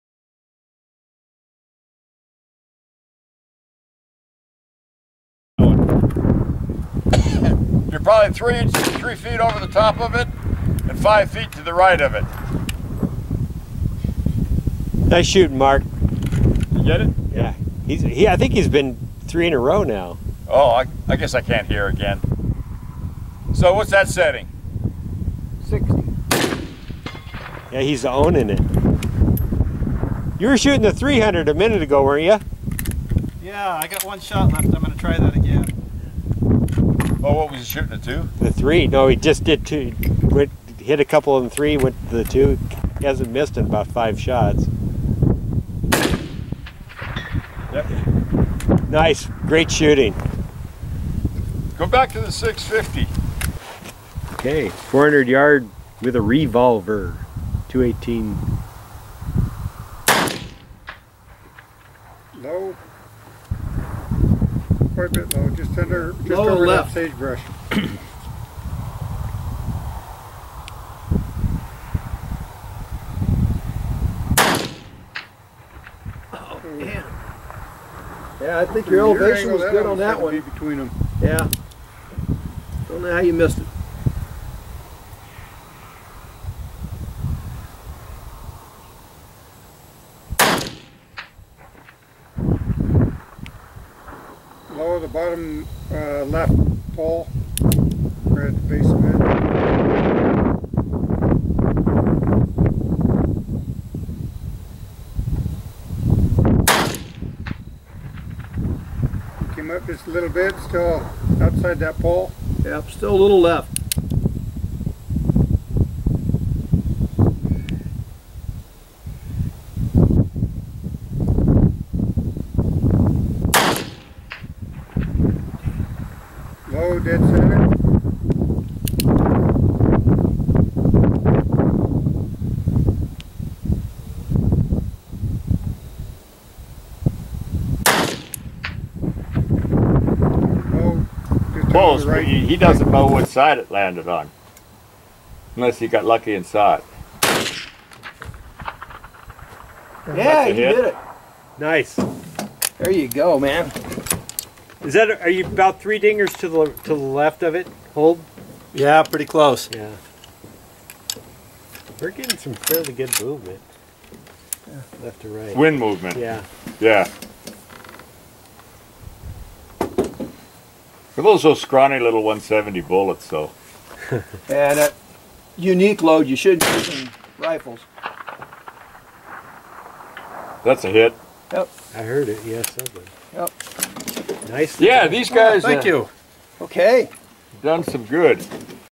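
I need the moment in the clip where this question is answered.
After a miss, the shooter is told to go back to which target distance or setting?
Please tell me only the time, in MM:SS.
00:52.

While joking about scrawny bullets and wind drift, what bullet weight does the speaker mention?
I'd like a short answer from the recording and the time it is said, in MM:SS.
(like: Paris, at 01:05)
170, at 02:52.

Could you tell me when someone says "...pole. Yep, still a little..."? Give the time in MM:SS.
01:51.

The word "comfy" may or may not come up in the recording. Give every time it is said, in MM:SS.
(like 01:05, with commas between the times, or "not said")
not said.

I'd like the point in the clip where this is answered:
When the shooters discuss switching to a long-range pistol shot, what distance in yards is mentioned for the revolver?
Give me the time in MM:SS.
00:54.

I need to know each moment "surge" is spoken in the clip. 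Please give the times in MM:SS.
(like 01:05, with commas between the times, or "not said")
not said.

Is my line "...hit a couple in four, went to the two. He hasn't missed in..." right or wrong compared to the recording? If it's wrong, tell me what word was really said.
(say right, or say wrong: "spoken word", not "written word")
wrong: "three", not "four".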